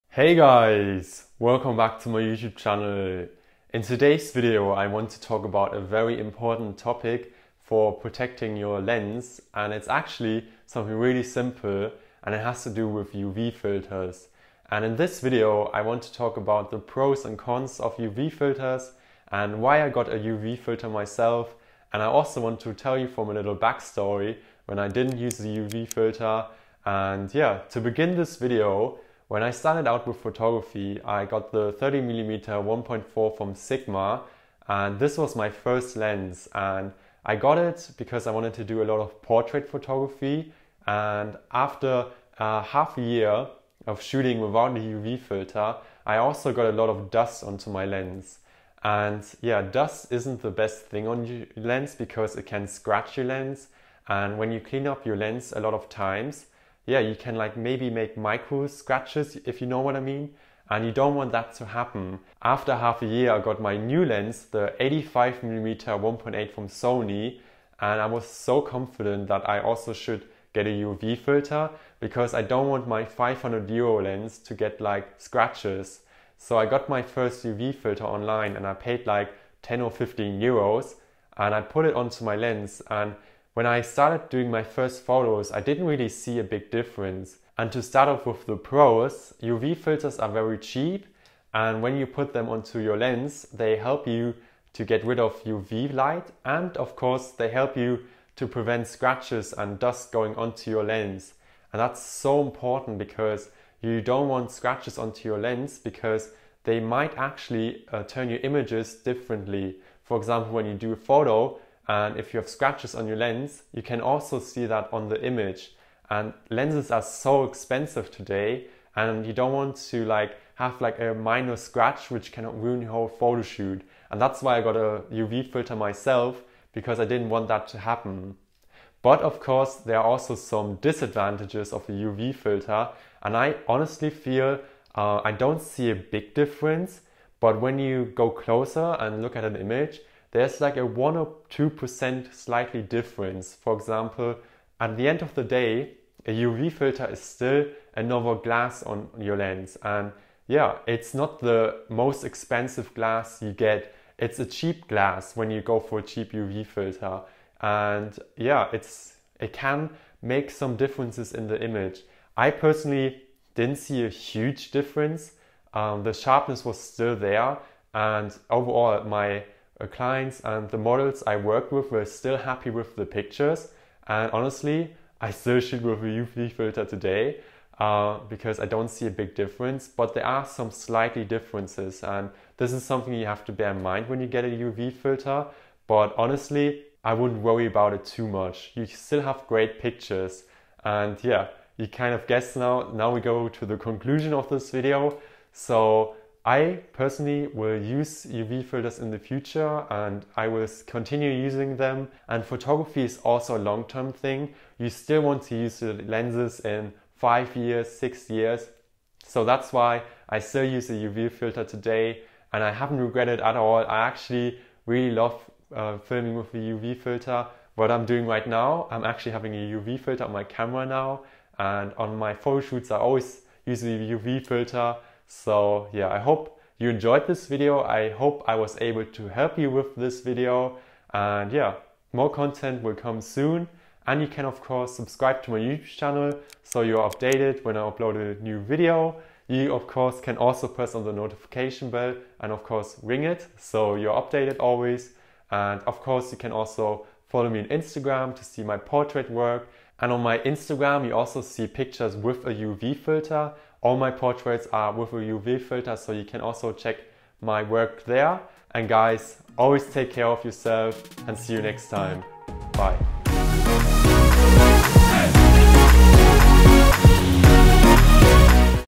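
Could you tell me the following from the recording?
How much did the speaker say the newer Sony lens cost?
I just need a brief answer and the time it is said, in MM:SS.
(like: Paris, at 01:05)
500 euros, at 01:13.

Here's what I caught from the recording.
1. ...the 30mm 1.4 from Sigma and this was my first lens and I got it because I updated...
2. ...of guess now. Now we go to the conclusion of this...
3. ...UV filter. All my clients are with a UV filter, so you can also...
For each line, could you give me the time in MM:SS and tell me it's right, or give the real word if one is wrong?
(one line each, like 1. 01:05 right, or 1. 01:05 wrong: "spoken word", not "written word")
1. 00:31 wrong: "wanted", not "updated"
2. 03:12 right
3. 04:12 wrong: "portraits", not "clients".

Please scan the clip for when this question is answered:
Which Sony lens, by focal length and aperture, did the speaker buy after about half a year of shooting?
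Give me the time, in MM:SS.
01:04.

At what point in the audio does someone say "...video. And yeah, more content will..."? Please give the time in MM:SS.
03:50.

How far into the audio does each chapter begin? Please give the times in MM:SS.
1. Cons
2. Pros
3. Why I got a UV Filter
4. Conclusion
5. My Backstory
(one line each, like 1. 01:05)
1. 02:08
2. 01:27
3. 01:03
4. 03:12
5. 00:22.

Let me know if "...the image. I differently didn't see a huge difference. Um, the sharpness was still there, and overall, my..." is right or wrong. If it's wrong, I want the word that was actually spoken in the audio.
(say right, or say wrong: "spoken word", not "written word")
wrong: "personally", not "differently".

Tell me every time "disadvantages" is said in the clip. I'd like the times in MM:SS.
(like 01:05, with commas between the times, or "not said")
02:10.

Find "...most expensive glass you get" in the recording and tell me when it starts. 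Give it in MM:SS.
02:31.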